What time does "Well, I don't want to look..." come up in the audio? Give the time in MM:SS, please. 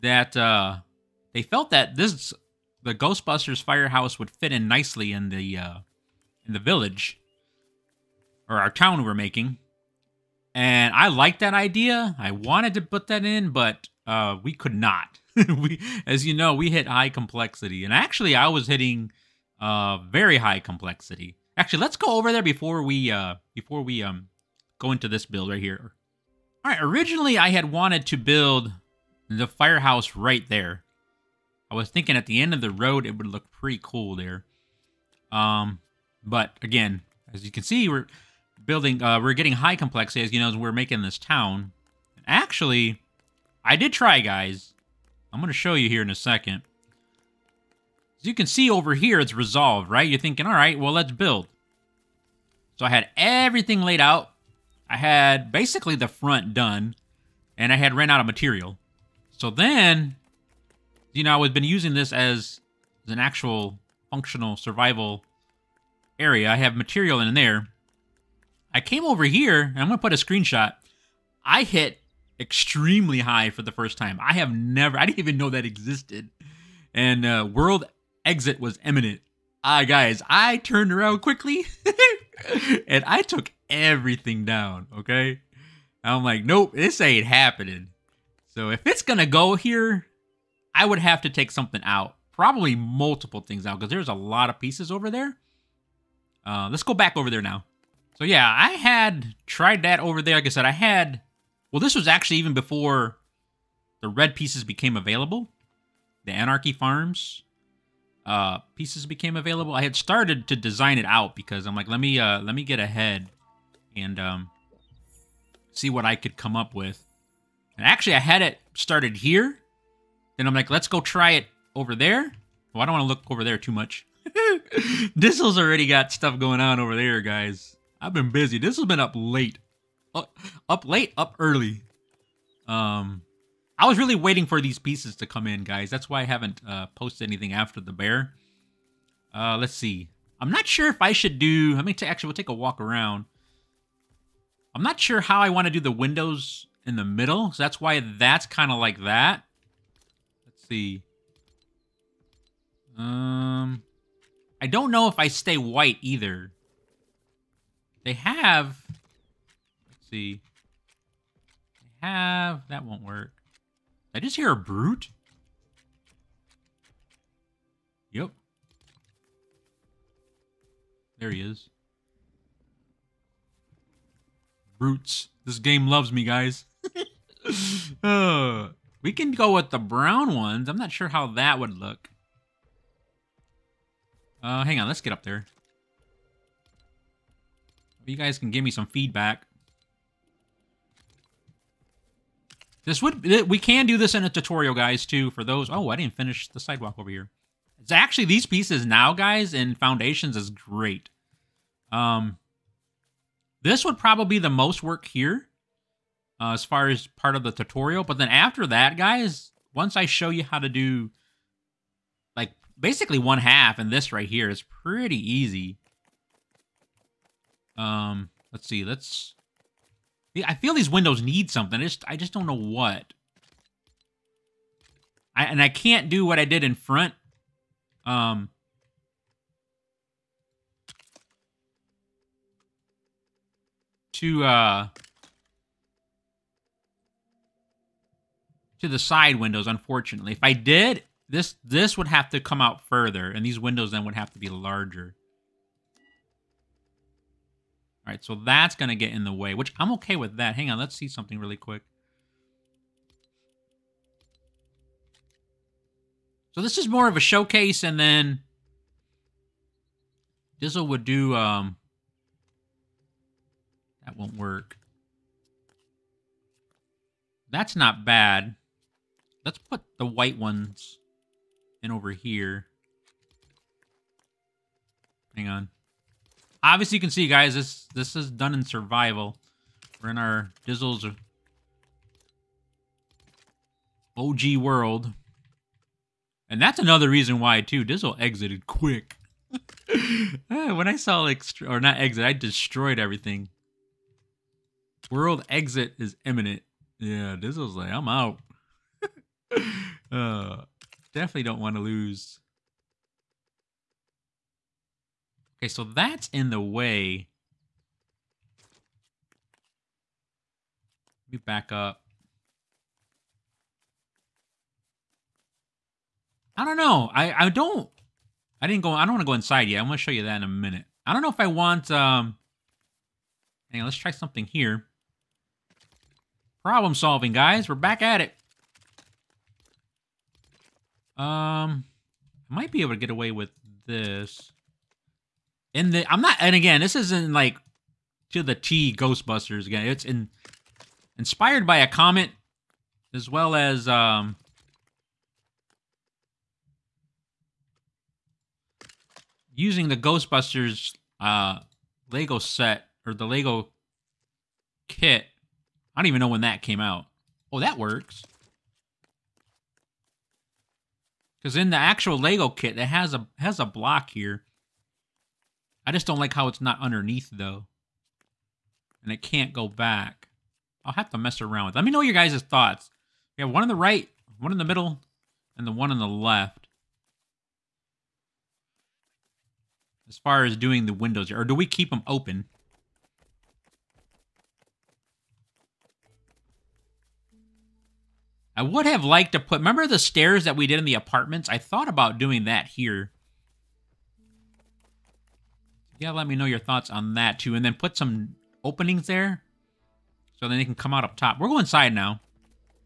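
02:02.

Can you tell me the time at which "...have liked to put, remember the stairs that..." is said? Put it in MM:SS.
06:28.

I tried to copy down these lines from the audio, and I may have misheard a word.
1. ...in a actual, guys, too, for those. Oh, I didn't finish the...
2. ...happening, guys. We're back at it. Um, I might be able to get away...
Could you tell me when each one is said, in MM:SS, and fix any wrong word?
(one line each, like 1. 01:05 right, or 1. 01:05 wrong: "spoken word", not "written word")
1. 03:14 wrong: "tutorial", not "actual"
2. 05:26 wrong: "solving", not "happening".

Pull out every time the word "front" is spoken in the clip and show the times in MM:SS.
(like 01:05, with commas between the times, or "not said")
00:56, 03:46.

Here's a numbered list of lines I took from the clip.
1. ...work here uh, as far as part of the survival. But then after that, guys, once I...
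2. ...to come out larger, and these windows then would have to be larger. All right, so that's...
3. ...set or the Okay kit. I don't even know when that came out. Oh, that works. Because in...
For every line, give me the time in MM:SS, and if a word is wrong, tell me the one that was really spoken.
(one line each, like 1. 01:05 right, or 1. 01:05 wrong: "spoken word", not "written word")
1. 03:24 wrong: "tutorial", not "survival"
2. 04:02 wrong: "further", not "larger"
3. 05:52 wrong: "Lego", not "Okay".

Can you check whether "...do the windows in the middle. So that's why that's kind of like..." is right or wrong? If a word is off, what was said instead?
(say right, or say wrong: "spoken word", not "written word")
right.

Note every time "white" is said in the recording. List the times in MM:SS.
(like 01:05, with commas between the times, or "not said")
02:35, 04:30.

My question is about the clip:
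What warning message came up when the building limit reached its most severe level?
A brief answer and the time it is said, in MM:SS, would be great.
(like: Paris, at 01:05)
World exit was imminent, at 01:17.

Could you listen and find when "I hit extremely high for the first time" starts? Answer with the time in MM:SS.
01:11.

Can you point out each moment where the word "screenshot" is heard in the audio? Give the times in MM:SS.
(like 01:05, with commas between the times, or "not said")
01:10.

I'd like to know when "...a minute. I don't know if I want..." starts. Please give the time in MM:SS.
05:20.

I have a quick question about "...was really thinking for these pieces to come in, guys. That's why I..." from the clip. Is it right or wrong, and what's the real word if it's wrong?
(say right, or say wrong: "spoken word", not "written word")
wrong: "waiting", not "thinking".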